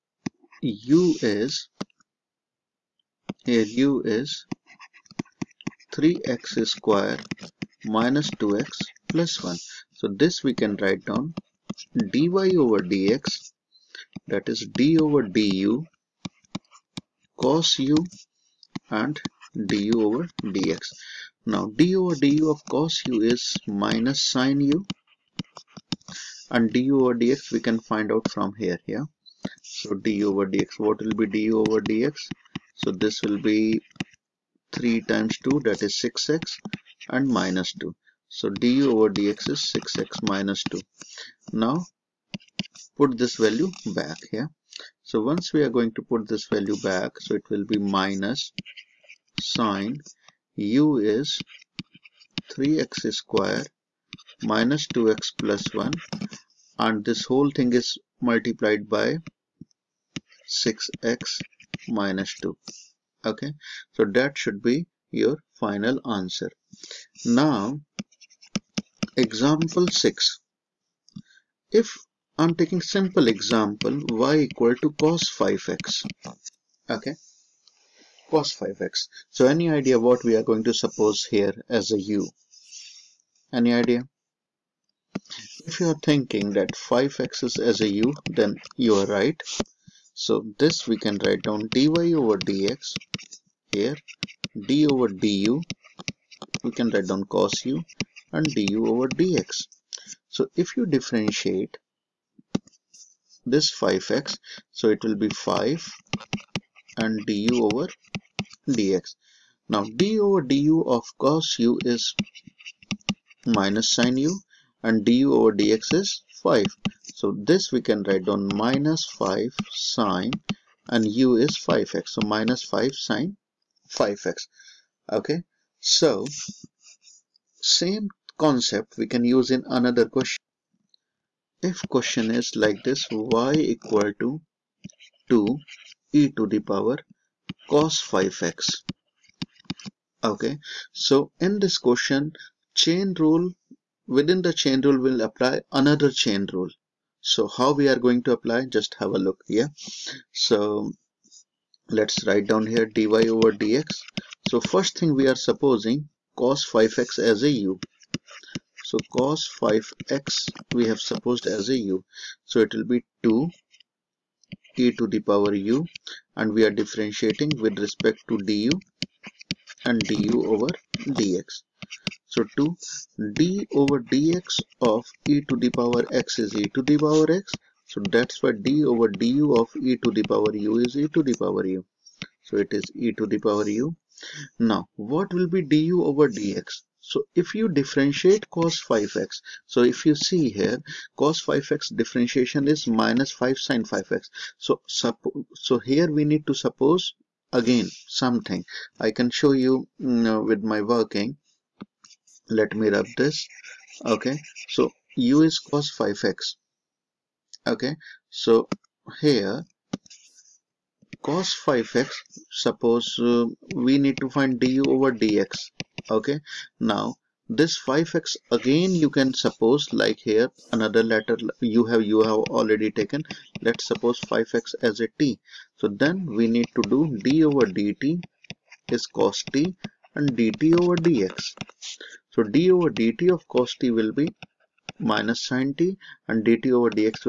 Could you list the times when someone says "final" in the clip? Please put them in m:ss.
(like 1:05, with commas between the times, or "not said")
1:05.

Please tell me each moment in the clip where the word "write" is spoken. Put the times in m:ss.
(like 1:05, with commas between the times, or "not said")
0:10, 1:31, 1:36, 1:58, 2:32.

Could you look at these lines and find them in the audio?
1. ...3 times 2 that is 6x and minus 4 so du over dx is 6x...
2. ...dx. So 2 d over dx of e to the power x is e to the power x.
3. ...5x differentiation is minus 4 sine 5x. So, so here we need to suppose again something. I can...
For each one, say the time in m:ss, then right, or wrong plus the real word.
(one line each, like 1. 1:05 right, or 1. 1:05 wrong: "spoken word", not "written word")
1. 0:34 wrong: "2", not "4"
2. 2:51 right
3. 3:11 wrong: "5", not "4".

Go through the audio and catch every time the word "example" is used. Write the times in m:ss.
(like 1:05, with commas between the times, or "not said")
1:09, 1:13.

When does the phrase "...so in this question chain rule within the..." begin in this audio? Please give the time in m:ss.
2:20.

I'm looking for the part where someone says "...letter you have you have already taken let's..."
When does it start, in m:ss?
3:41.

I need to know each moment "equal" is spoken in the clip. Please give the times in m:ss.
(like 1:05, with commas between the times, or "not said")
1:14, 2:13.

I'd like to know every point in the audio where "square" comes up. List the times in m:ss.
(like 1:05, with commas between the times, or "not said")
0:06, 0:53.